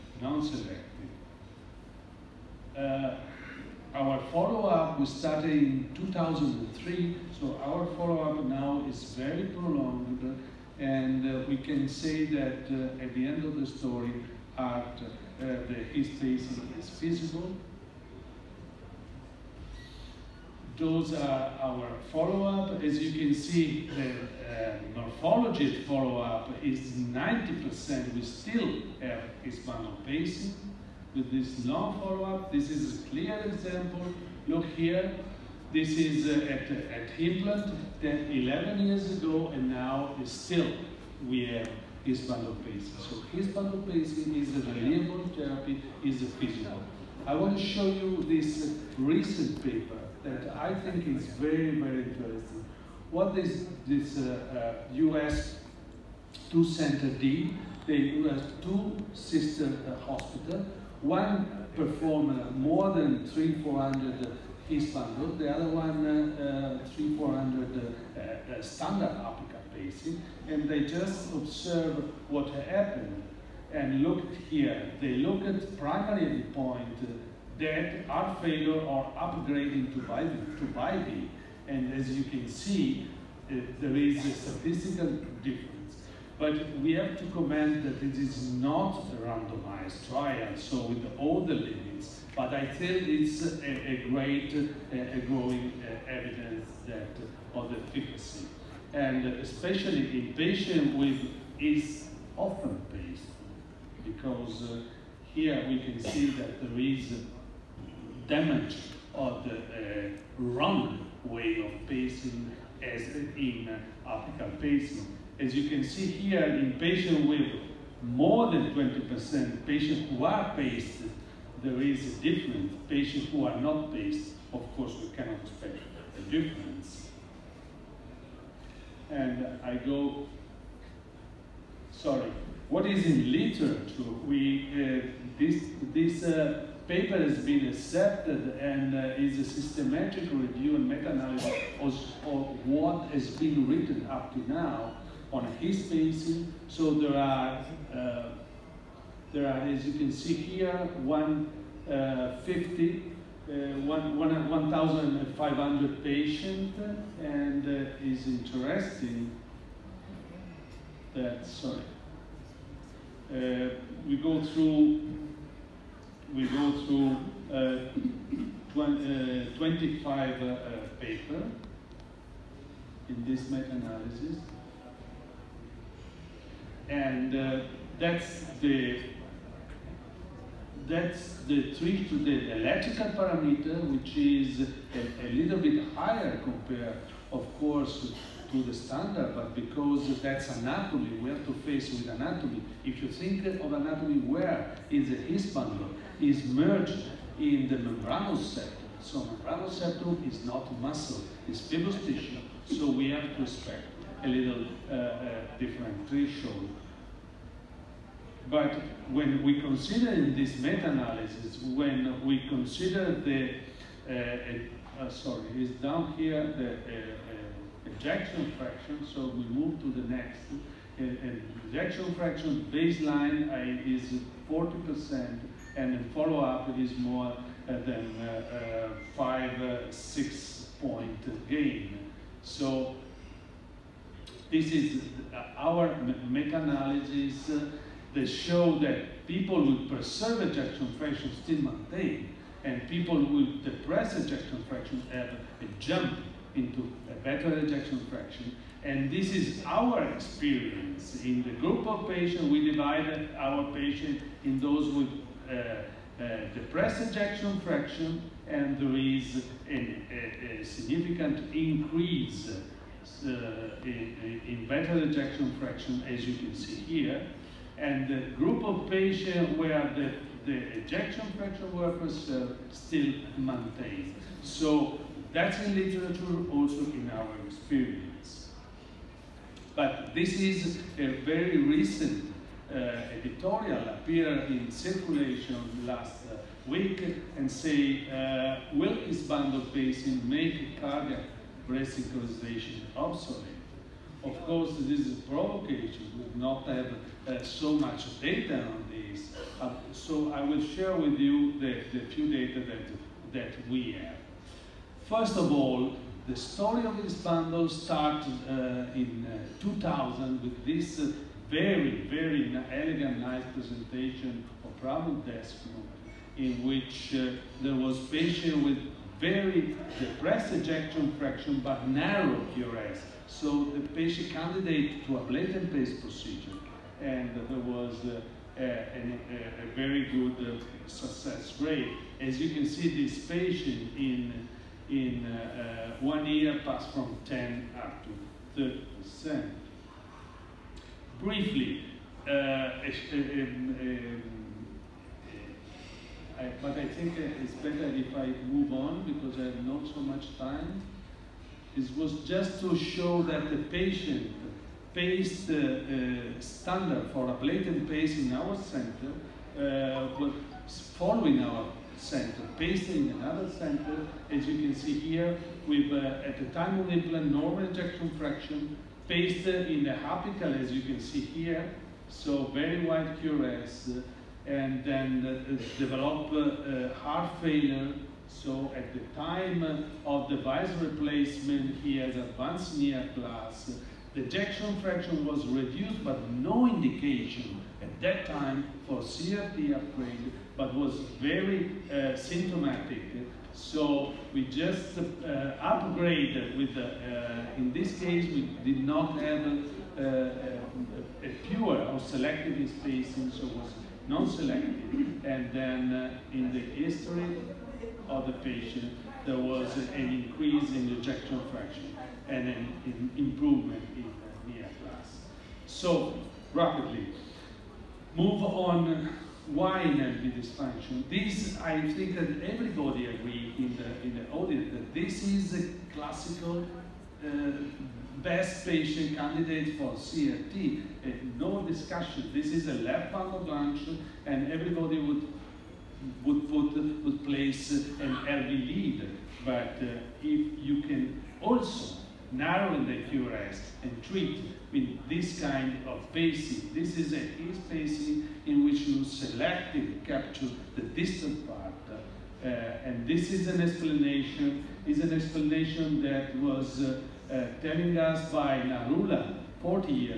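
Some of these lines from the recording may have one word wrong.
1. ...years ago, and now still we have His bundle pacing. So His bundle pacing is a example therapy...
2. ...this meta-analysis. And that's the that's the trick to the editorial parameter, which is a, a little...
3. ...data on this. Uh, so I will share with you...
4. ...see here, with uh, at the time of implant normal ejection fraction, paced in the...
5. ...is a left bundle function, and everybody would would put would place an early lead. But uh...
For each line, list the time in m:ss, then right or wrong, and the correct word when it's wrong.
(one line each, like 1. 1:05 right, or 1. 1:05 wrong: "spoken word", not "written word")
1. 0:38 wrong: "reliable", not "example"
2. 2:53 wrong: "electrical", not "editorial"
3. 4:58 right
4. 6:04 right
5. 7:12 right.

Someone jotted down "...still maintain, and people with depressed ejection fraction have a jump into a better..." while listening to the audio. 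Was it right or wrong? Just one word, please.
right.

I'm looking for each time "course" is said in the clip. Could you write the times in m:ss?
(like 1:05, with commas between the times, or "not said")
2:04, 3:07, 4:54.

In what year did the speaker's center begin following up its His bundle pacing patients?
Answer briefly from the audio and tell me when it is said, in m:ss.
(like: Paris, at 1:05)
2003, at 0:05.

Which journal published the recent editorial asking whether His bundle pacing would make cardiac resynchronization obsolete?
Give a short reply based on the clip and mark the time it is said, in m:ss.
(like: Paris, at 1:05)
Circulation, at 4:44.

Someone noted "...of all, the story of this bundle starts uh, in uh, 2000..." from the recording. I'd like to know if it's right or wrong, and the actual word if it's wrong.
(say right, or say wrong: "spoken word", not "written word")
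right.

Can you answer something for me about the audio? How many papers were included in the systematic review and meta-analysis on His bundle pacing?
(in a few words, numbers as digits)
25.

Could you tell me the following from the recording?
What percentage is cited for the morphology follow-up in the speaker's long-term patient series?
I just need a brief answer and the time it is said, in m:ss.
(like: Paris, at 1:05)
90%, at 0:26.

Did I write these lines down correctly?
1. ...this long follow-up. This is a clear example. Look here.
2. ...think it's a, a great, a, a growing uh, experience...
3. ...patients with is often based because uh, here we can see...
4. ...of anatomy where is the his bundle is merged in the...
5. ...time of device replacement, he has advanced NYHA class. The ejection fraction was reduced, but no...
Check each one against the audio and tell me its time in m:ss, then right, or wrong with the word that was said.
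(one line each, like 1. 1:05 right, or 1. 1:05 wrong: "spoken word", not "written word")
1. 0:31 right
2. 1:32 wrong: "evidence", not "experience"
3. 1:40 right
4. 3:13 right
5. 6:19 right.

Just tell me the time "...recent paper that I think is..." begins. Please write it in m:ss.
0:48.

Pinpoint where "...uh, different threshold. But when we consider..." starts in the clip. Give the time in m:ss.
3:24.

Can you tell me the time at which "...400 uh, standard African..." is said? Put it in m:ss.
1:07.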